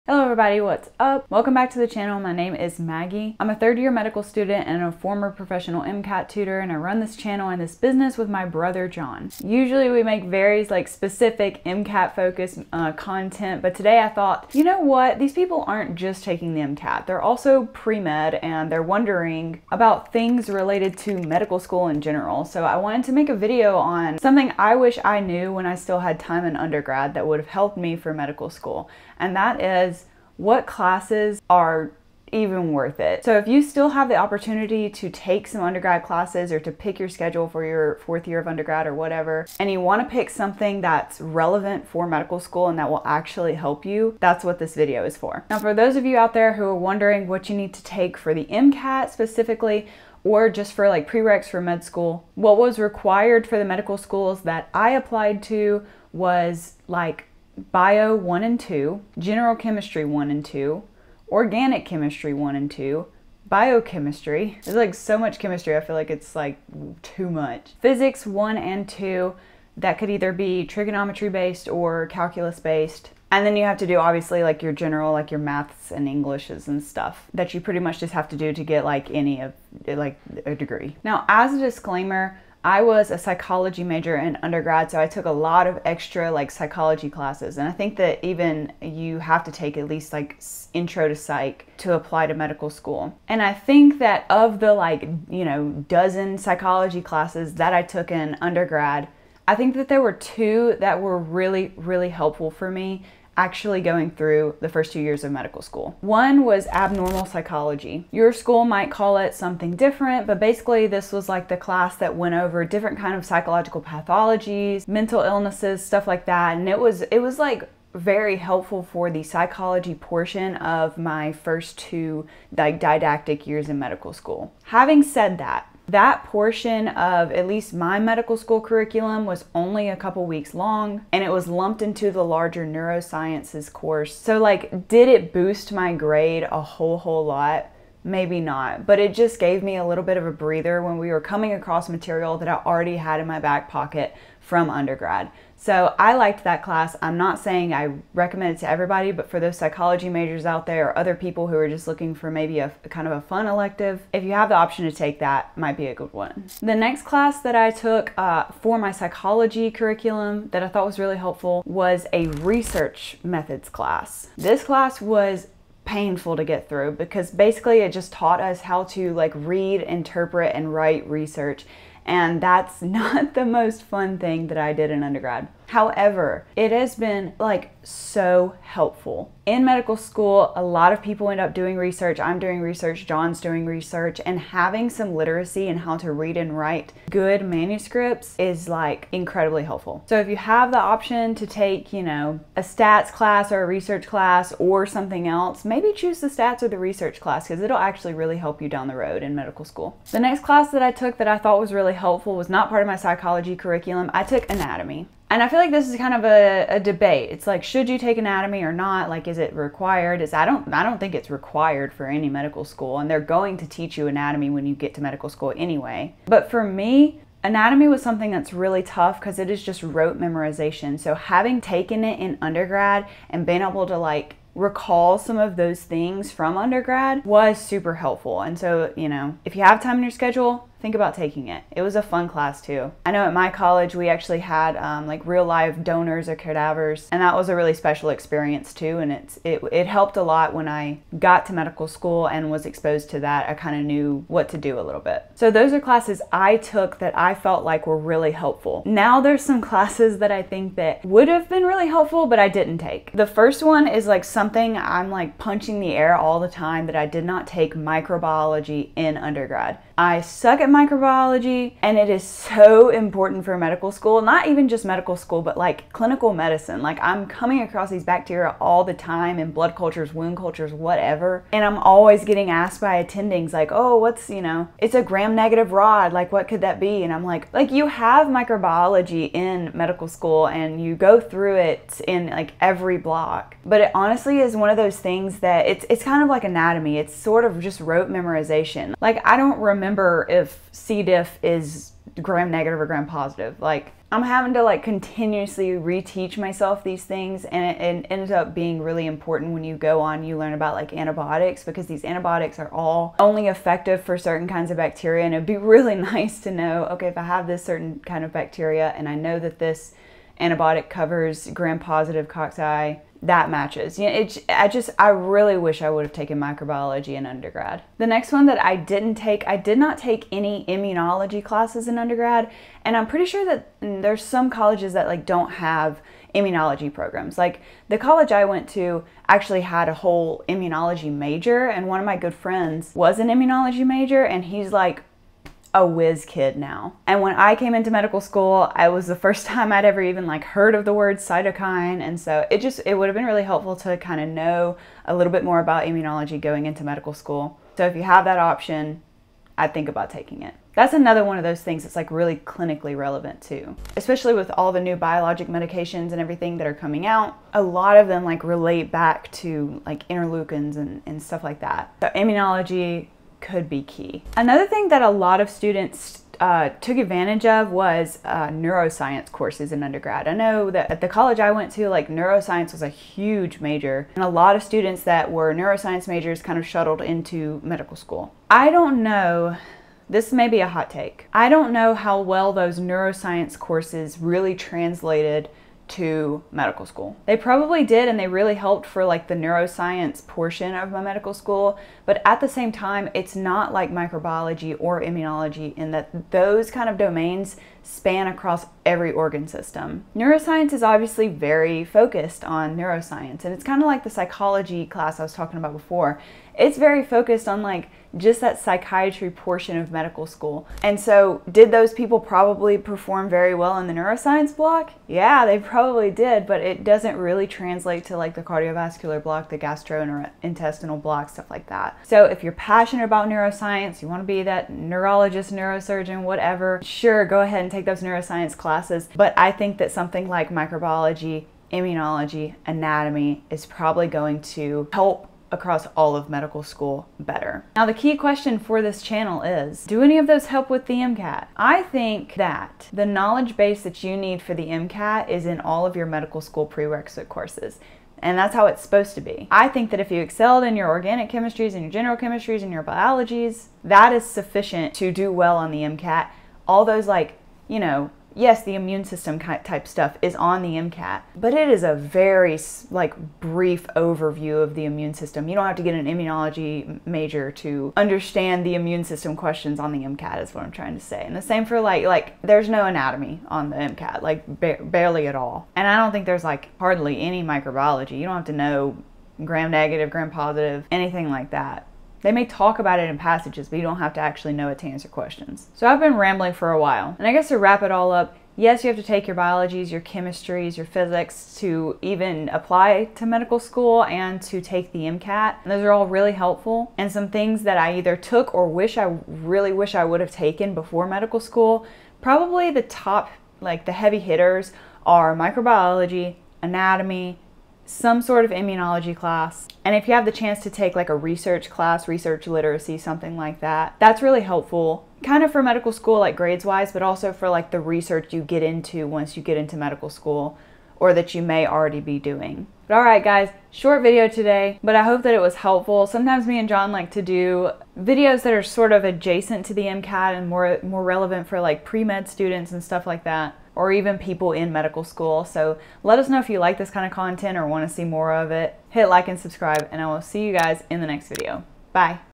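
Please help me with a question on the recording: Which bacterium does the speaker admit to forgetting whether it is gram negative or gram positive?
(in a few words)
C. diff.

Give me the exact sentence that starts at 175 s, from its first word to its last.
However, it has been like so helpful.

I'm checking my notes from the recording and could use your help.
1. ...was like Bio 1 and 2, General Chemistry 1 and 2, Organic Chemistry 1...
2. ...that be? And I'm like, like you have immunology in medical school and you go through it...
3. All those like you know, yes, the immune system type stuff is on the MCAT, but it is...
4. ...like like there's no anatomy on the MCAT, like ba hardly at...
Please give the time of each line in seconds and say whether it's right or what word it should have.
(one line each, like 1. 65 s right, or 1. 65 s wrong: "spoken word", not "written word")
1. 56 s right
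2. 276 s wrong: "microbiology", not "immunology"
3. 456 s right
4. 471 s wrong: "barely", not "hardly".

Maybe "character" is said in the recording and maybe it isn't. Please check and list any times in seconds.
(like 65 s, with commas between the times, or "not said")
not said.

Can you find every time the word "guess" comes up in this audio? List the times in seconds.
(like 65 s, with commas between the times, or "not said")
487 s.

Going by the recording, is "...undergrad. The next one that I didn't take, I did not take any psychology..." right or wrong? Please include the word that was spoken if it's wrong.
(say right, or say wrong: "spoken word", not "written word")
wrong: "immunology", not "psychology".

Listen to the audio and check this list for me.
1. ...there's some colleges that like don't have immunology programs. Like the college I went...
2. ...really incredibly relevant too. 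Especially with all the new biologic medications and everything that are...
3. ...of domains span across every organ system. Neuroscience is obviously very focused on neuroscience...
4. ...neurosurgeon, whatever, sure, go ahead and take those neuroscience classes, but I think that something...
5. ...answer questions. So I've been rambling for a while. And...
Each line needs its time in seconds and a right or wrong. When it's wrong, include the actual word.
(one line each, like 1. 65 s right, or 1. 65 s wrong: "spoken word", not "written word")
1. 324 s right
2. 352 s wrong: "clinically", not "incredibly"
3. 396 s right
4. 425 s right
5. 484 s right.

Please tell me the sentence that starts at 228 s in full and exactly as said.
And so, you know, if you have time in your schedule, think about taking it.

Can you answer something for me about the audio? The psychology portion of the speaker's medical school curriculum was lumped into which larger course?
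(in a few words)
Neurosciences course.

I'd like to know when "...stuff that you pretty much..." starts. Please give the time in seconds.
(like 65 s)
76 s.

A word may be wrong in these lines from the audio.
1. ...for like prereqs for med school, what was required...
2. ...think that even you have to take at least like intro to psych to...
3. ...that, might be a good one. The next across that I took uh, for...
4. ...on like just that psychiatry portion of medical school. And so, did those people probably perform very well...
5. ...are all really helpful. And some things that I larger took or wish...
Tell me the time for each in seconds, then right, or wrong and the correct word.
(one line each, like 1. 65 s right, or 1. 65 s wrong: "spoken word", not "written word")
1. 50 s right
2. 87 s right
3. 155 s wrong: "class", not "across"
4. 407 s right
5. 495 s wrong: "either", not "larger".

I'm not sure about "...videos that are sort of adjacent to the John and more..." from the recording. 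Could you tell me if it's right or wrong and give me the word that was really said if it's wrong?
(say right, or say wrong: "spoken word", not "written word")
wrong: "MCAT", not "John".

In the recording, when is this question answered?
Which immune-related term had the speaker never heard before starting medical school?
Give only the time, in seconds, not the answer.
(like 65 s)
341 s.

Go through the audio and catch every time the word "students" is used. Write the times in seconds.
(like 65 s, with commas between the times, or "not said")
4 s, 365 s, 374 s, 532 s.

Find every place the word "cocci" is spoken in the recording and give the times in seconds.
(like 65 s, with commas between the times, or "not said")
312 s.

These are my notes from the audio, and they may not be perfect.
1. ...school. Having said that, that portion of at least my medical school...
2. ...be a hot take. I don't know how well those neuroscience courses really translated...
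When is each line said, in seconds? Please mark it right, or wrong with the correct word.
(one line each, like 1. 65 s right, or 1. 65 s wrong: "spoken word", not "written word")
1. 124 s right
2. 380 s right.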